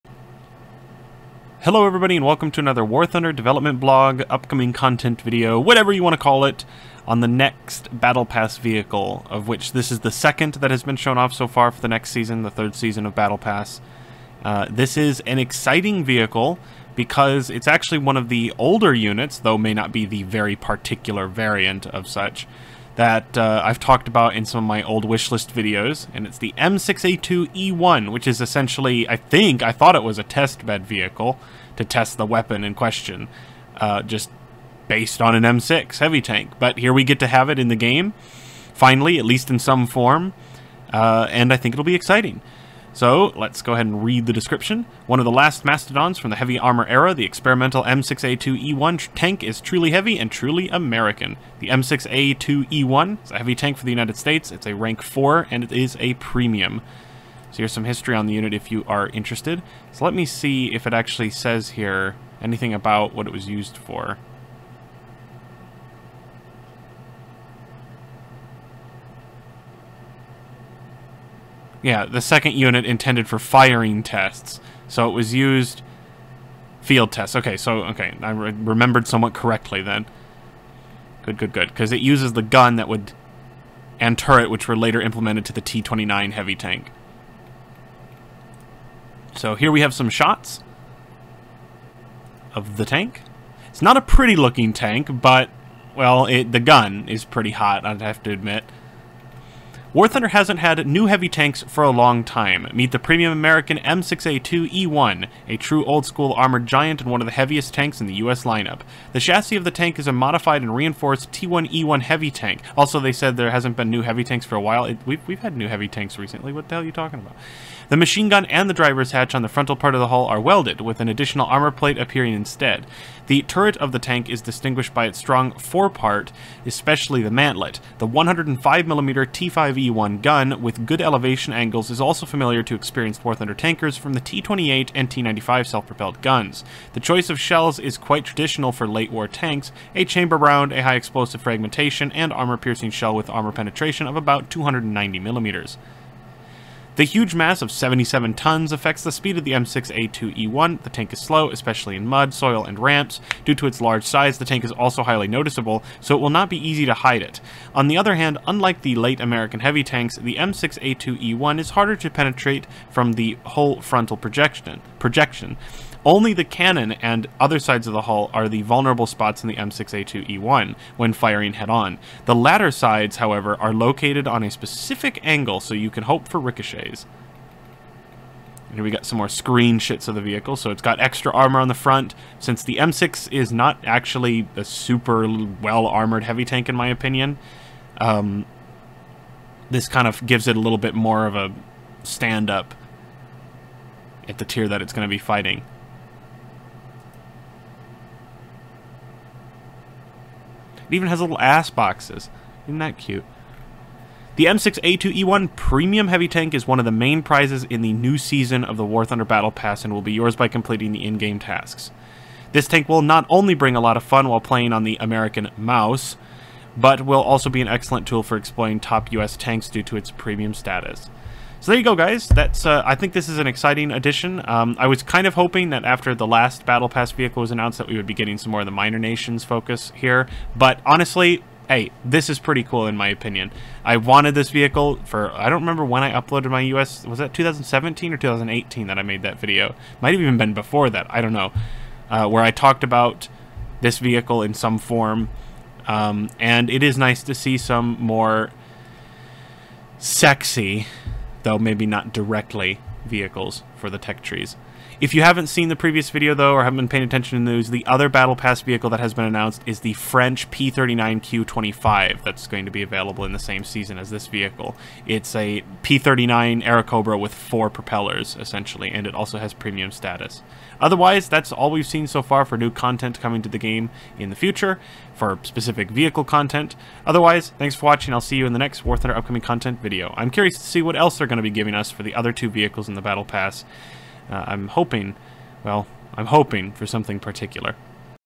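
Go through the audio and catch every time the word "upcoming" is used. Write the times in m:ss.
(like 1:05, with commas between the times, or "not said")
0:04, 4:39.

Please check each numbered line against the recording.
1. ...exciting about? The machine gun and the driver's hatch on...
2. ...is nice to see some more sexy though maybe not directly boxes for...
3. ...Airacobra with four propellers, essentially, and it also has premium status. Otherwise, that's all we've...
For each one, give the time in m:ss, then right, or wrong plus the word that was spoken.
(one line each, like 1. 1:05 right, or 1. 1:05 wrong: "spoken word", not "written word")
1. 1:56 wrong: "talking", not "exciting"
2. 4:06 wrong: "vehicles", not "boxes"
3. 4:26 right.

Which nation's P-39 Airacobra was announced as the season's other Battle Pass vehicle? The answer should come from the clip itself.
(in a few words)
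French.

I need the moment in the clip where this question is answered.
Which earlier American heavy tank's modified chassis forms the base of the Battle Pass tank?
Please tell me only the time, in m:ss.
1:51.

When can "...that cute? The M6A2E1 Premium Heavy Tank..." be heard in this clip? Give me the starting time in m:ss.
3:22.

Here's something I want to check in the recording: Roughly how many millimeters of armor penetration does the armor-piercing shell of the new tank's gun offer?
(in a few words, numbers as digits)
290 millimeters.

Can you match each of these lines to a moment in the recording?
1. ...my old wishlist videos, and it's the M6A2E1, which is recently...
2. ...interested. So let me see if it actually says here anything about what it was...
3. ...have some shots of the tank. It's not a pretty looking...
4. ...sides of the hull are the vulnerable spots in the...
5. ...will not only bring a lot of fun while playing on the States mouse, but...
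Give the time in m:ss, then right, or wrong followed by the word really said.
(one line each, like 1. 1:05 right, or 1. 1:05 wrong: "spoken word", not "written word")
1. 0:24 wrong: "essentially", not "recently"
2. 0:59 right
3. 1:29 right
4. 2:47 right
5. 3:32 wrong: "American", not "States".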